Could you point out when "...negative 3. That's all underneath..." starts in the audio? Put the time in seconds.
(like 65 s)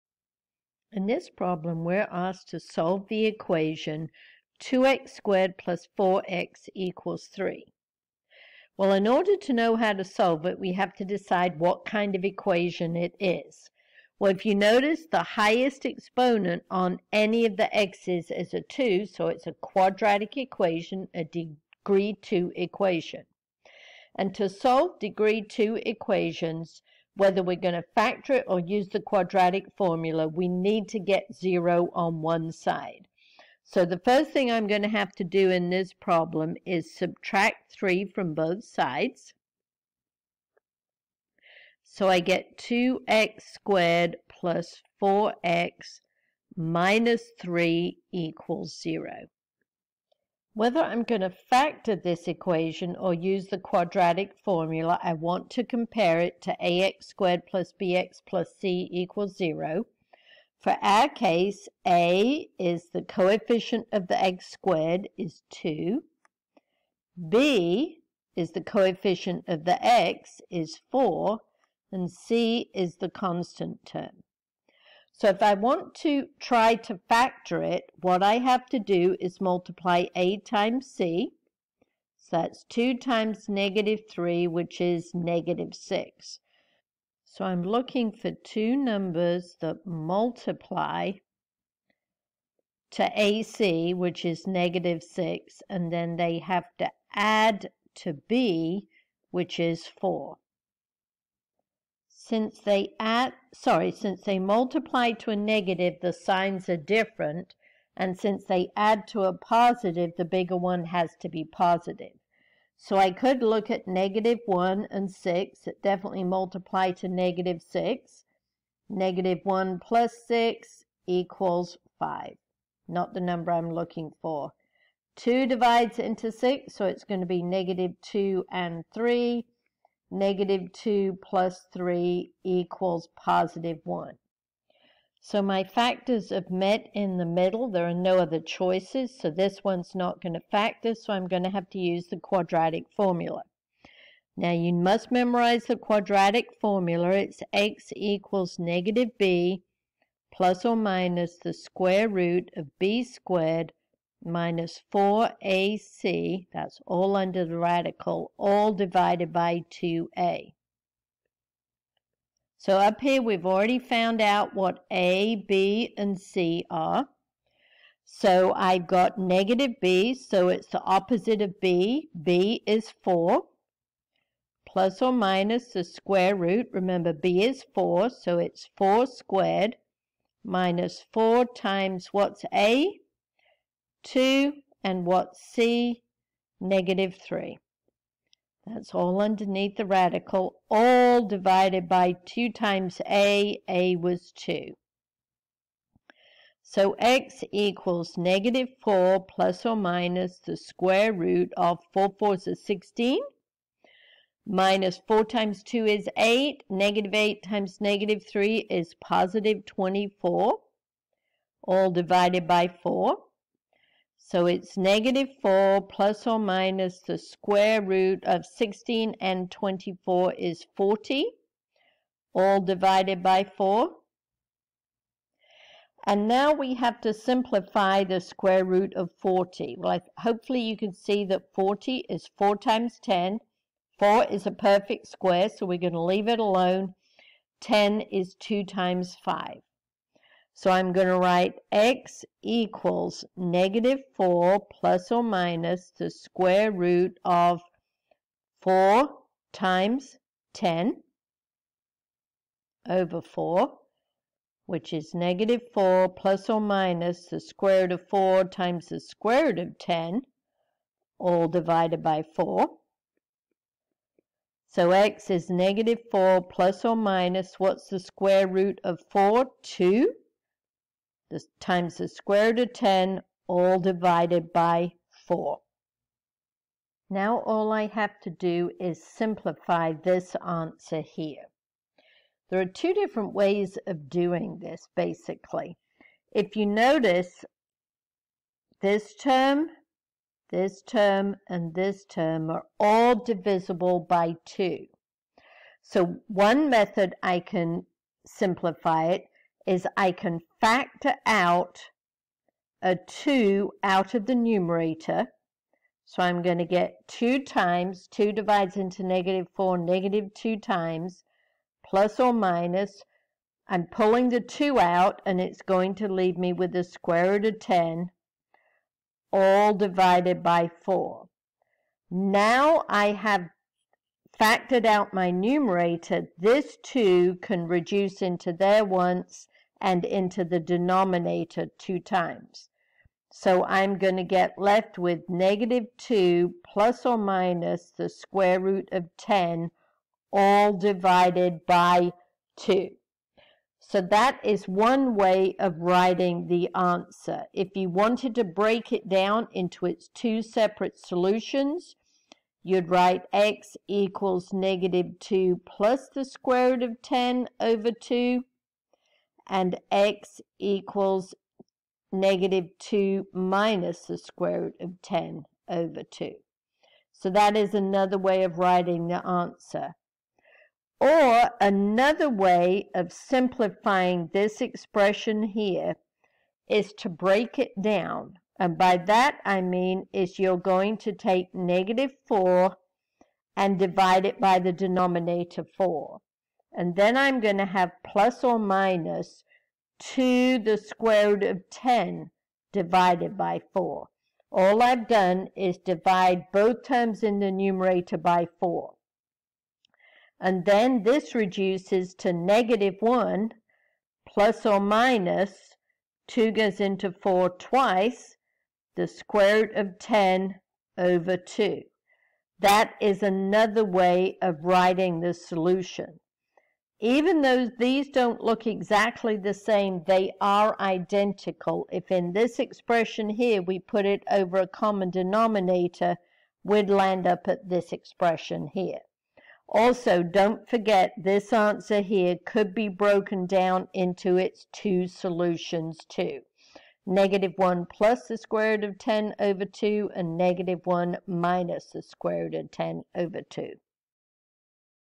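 186 s.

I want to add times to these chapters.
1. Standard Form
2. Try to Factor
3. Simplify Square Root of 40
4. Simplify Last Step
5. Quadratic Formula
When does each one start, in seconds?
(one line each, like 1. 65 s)
1. 50 s
2. 74 s
3. 228 s
4. 276 s
5. 140 s.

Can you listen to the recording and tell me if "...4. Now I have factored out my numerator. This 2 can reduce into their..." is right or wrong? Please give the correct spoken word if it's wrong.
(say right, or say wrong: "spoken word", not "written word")
right.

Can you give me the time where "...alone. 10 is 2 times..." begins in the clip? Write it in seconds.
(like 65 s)
236 s.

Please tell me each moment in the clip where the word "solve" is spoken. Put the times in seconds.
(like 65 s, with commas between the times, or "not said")
2 s, 10 s, 24 s.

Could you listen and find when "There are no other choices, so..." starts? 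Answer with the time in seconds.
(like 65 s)
137 s.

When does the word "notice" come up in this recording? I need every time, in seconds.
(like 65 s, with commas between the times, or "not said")
14 s, 286 s.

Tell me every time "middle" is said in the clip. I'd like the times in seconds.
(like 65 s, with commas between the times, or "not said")
137 s.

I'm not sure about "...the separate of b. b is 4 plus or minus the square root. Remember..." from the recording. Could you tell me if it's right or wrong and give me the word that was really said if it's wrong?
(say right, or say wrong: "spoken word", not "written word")
wrong: "opposite", not "separate".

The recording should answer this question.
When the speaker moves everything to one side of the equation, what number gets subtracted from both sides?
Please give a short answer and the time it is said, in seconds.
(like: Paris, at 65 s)
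3, at 36 s.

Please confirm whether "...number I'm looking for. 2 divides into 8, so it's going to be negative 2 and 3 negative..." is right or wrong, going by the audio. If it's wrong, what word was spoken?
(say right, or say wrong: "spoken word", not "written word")
wrong: "6", not "8".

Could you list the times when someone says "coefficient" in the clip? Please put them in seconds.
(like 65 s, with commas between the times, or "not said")
63 s, 68 s.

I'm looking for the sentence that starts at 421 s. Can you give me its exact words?
If in this expression here we put it over a common denominator, we'd land up at this expression here.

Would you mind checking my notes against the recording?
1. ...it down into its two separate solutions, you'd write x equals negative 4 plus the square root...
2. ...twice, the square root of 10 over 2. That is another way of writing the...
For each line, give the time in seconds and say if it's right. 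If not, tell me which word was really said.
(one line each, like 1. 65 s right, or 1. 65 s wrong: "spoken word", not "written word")
1. 348 s wrong: "2", not "4"
2. 407 s right.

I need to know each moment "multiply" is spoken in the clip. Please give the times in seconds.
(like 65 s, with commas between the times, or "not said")
79 s, 89 s, 104 s, 116 s.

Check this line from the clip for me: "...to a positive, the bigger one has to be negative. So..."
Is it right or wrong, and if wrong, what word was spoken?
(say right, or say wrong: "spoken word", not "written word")
wrong: "positive", not "negative".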